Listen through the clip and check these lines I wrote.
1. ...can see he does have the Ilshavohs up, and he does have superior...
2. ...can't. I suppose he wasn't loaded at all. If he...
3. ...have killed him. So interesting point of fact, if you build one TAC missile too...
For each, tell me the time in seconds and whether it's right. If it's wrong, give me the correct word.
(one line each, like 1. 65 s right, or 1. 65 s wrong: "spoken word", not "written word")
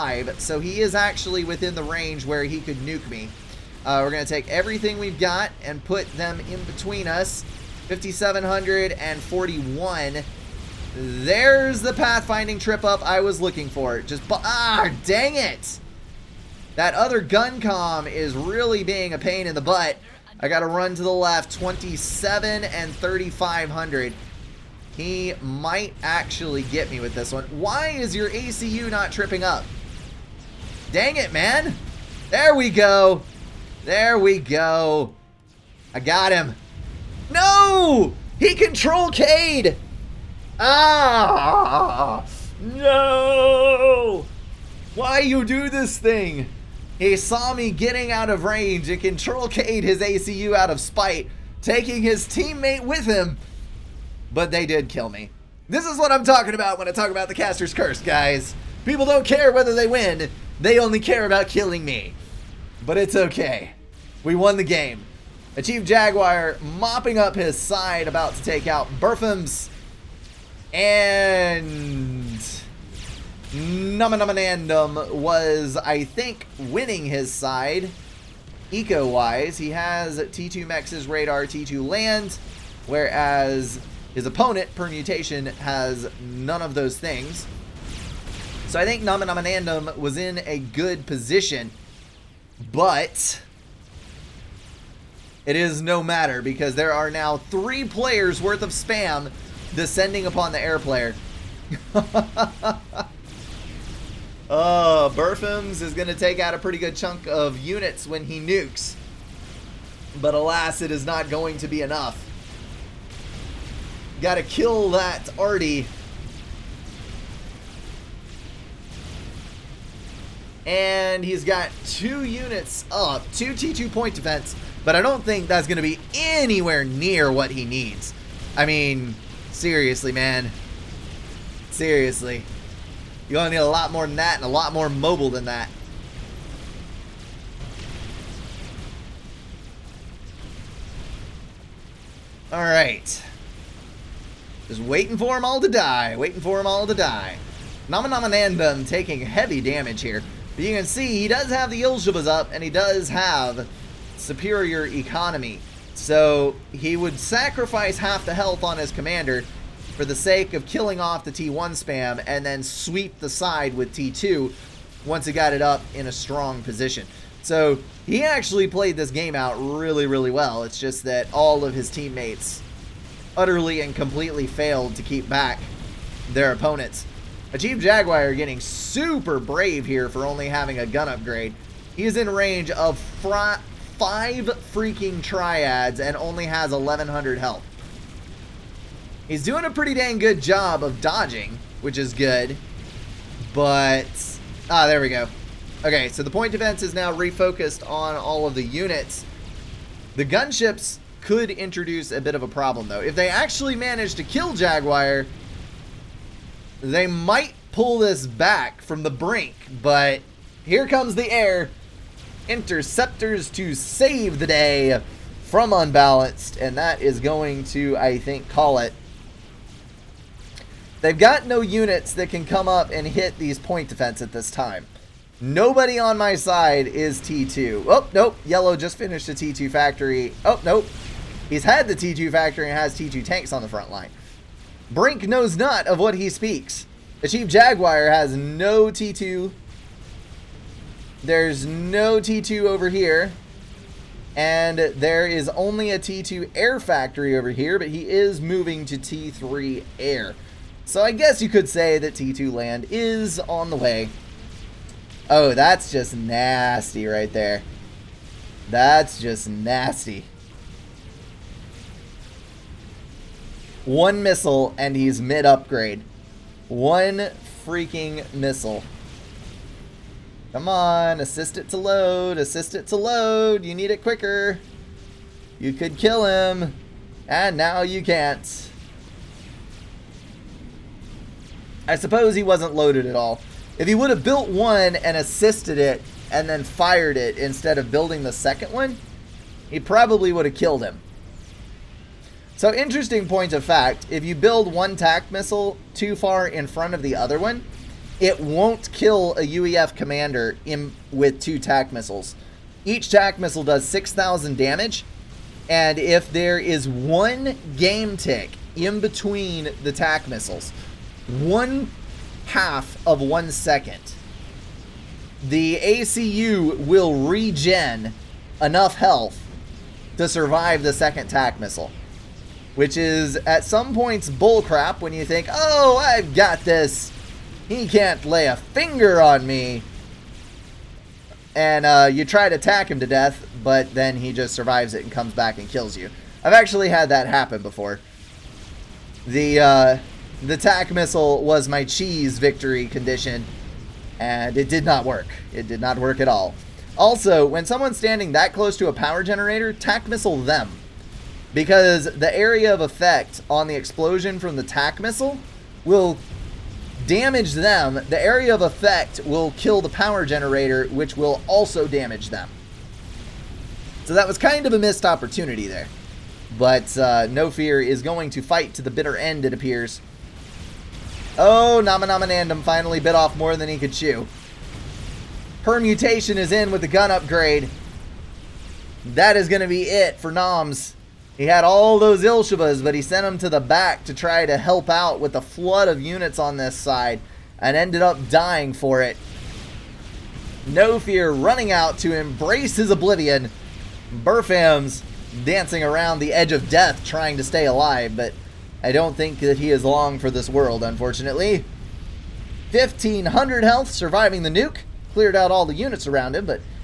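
1. 150 s right
2. 278 s right
3. 290 s right.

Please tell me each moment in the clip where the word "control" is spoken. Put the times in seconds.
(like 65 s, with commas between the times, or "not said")
38 s, 49 s.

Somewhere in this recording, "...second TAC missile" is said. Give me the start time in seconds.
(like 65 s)
320 s.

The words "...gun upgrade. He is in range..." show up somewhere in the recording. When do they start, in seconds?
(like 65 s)
180 s.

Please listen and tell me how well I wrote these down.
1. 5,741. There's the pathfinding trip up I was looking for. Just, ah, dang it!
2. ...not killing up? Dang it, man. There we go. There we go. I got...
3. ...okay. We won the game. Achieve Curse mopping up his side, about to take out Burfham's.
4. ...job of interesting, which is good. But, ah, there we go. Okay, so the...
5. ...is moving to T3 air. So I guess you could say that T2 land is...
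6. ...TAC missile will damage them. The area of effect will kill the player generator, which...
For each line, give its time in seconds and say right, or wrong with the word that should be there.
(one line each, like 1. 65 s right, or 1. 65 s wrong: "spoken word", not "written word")
1. 7 s right
2. 28 s wrong: "tripping", not "killing"
3. 63 s wrong: "Jaguar", not "Curse"
4. 190 s wrong: "dodging", not "interesting"
5. 248 s right
6. 354 s wrong: "power", not "player".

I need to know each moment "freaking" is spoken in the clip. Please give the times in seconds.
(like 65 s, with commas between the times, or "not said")
184 s, 267 s.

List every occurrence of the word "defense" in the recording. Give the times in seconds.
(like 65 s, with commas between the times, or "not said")
124 s, 196 s, 223 s.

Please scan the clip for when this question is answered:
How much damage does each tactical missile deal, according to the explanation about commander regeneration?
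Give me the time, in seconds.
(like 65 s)
303 s.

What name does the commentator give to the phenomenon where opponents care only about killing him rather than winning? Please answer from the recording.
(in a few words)
Caster's Curse.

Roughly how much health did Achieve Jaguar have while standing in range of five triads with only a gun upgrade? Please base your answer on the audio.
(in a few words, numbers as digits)
1,100.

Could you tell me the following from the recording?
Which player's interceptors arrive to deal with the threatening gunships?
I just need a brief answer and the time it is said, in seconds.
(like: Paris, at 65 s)
Unbalanced, at 215 s.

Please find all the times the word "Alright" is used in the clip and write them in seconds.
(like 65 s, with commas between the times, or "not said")
142 s.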